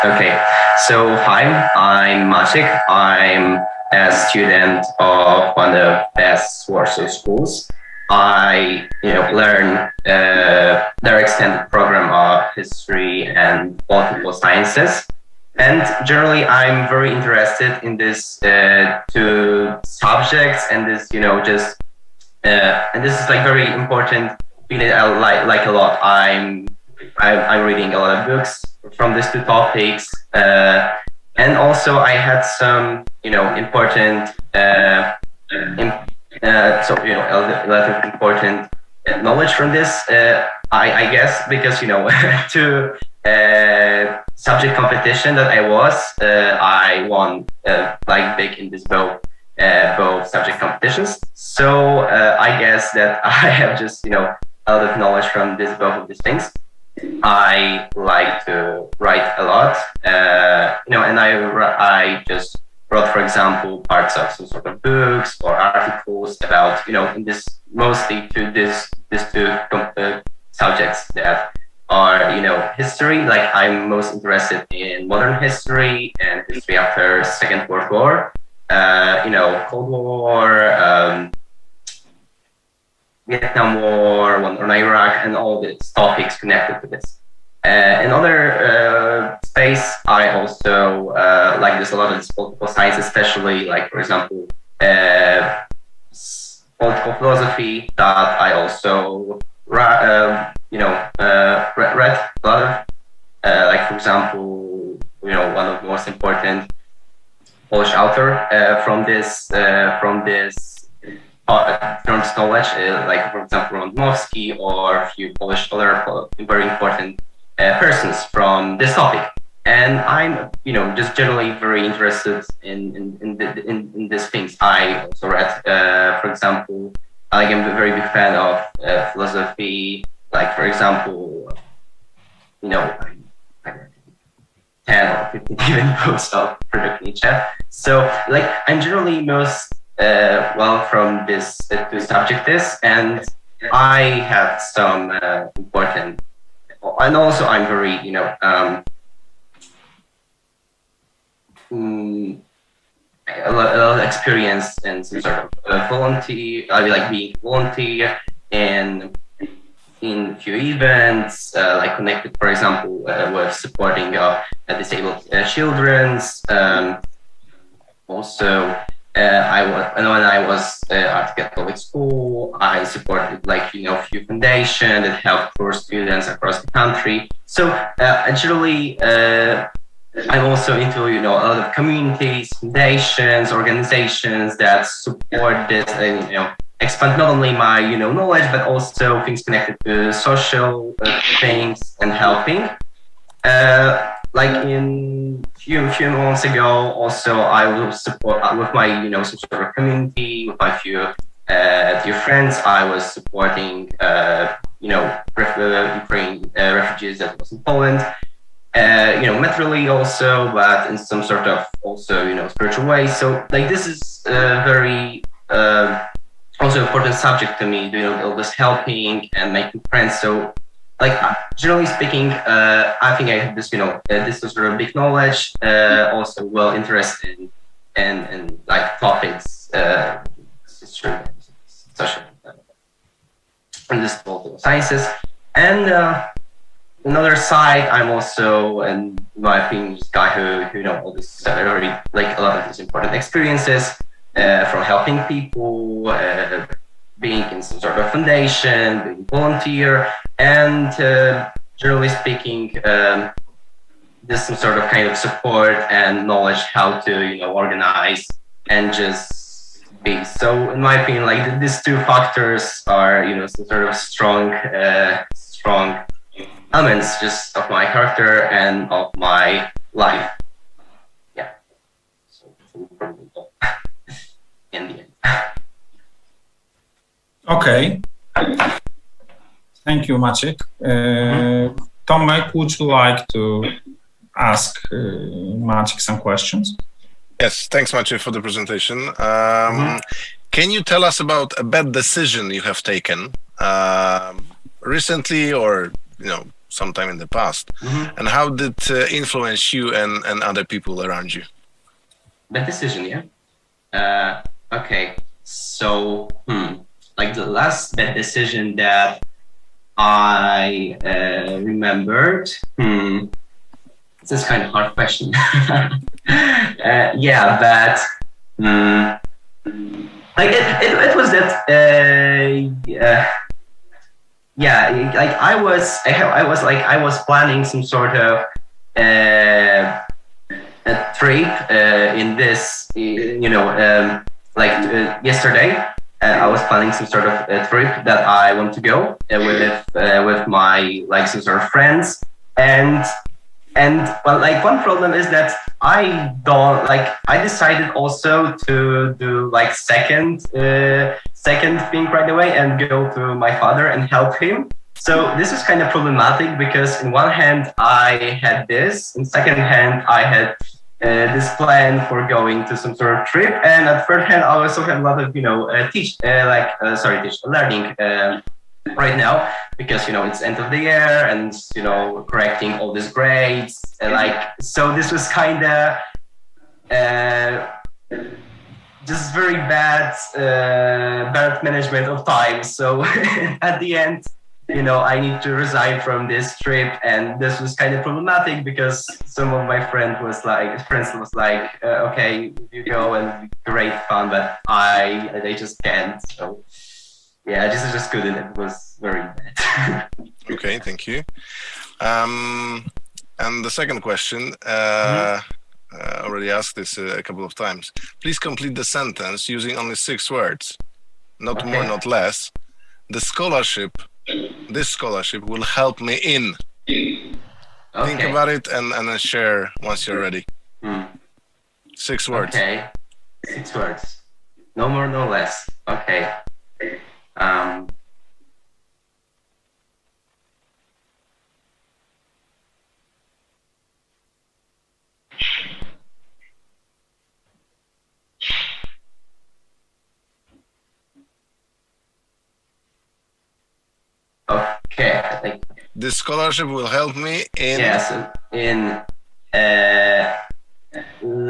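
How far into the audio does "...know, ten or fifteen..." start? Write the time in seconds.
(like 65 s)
132 s.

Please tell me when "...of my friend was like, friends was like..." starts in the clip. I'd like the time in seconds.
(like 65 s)
389 s.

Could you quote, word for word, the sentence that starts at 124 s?
I also read, for example, like I'm a very big fan of uh, philosophy.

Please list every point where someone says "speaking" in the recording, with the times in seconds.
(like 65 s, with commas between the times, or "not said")
221 s, 252 s.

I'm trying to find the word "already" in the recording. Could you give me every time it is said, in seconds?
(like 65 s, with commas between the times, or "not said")
241 s, 406 s.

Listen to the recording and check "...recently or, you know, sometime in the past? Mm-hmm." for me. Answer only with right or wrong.
right.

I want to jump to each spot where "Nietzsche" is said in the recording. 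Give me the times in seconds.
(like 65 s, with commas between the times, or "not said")
137 s.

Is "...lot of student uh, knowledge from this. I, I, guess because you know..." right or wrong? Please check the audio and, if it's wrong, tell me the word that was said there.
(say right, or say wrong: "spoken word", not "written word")
wrong: "important", not "student".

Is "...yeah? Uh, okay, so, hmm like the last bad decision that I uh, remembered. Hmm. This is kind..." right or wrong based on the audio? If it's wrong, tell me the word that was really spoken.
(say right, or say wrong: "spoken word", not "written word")
right.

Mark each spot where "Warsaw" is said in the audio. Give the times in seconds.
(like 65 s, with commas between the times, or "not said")
6 s.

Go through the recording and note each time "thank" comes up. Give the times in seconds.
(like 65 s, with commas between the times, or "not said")
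279 s, 287 s, 400 s.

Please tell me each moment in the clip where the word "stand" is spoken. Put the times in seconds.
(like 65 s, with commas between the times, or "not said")
not said.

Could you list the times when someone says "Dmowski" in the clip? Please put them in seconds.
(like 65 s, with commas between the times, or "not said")
113 s.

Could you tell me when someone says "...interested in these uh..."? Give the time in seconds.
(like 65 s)
17 s.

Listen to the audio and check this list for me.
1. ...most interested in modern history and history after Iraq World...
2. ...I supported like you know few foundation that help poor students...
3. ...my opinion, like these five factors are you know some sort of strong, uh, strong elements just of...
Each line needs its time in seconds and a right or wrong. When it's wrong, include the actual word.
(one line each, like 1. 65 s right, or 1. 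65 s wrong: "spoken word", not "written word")
1. 73 s wrong: "Second", not "Iraq"
2. 172 s right
3. 260 s wrong: "two", not "five".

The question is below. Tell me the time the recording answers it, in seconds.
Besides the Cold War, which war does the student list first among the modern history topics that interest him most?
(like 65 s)
83 s.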